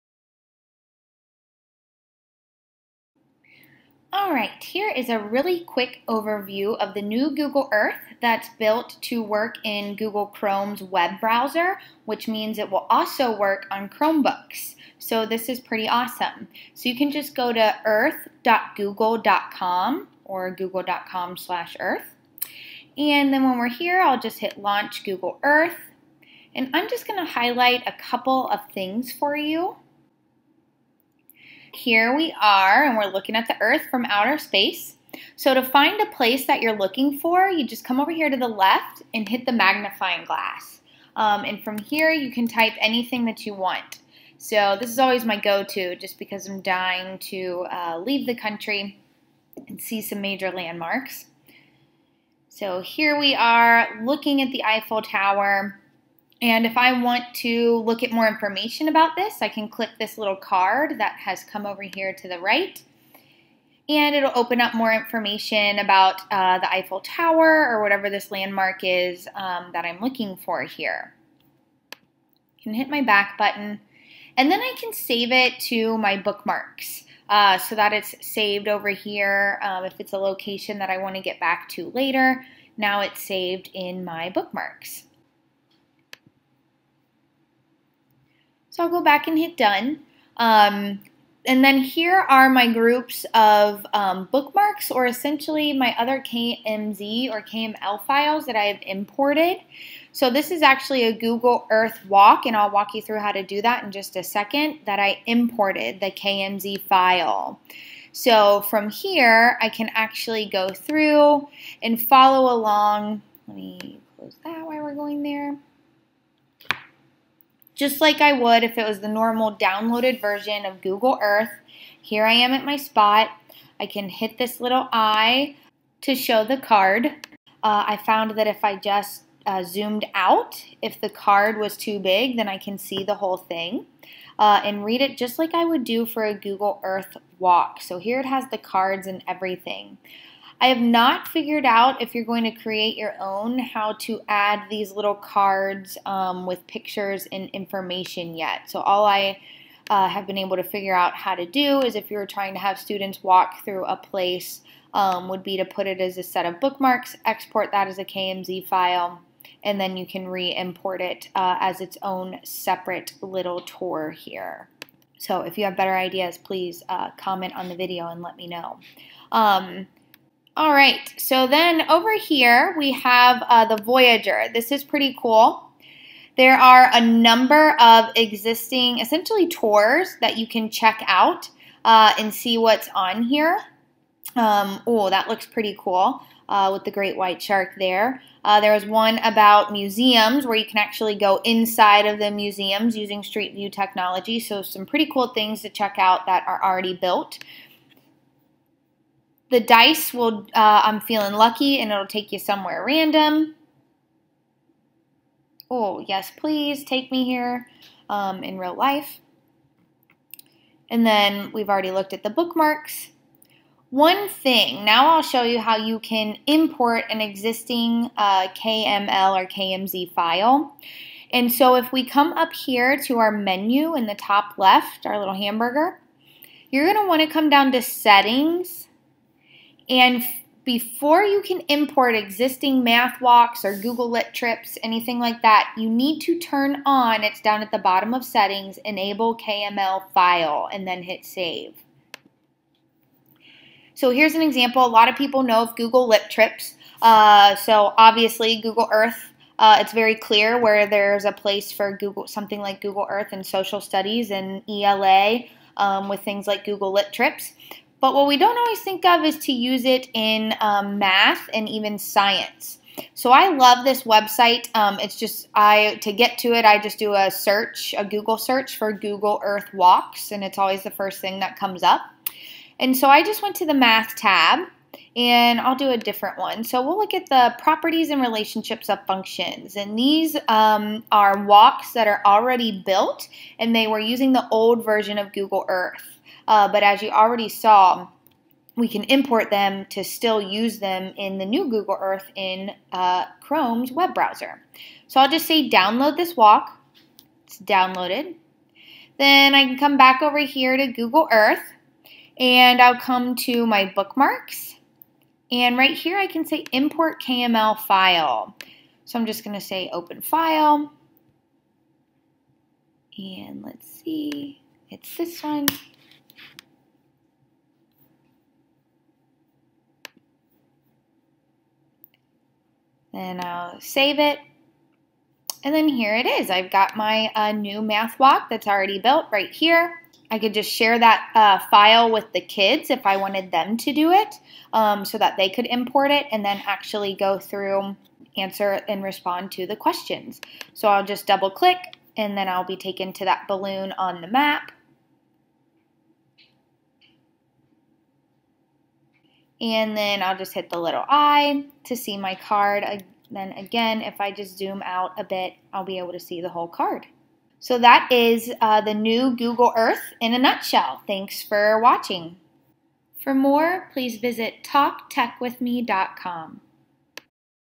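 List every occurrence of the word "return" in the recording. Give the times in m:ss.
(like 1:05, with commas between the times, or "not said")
not said.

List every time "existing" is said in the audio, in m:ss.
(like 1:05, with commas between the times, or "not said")
2:58, 3:37, 3:52.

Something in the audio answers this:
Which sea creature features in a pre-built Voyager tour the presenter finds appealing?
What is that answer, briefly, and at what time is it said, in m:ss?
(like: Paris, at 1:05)
great white shark, at 3:06.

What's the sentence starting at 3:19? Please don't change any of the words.
The dice will, uh, I'm feeling lucky, and it'll take you somewhere random.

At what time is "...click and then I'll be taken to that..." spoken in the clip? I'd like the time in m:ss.
5:41.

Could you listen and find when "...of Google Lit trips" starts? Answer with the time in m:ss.
4:05.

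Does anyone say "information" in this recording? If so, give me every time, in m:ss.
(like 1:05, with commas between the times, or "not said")
0:58, 1:04, 2:27.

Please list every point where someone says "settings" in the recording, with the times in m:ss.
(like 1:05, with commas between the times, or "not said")
3:47, 3:58.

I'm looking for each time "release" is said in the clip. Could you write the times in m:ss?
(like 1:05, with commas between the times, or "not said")
not said.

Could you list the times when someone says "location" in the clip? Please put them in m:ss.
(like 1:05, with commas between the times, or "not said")
1:20.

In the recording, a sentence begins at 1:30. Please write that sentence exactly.
Um, and then here are my groups of um, bookmarks or essentially my other KMZ or KML files that I have imported.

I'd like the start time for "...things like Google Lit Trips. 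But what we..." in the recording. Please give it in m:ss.
4:16.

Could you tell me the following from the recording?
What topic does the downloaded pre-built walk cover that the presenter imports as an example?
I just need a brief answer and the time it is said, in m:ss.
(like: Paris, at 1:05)
properties and relationships of functions, at 4:37.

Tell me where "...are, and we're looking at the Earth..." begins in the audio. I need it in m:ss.
0:32.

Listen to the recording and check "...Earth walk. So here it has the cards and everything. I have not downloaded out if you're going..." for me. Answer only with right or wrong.
wrong.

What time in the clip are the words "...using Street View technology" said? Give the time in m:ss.
3:12.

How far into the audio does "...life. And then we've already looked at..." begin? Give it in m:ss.
3:28.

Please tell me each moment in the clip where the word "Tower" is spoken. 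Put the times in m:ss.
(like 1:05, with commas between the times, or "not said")
0:55, 1:07.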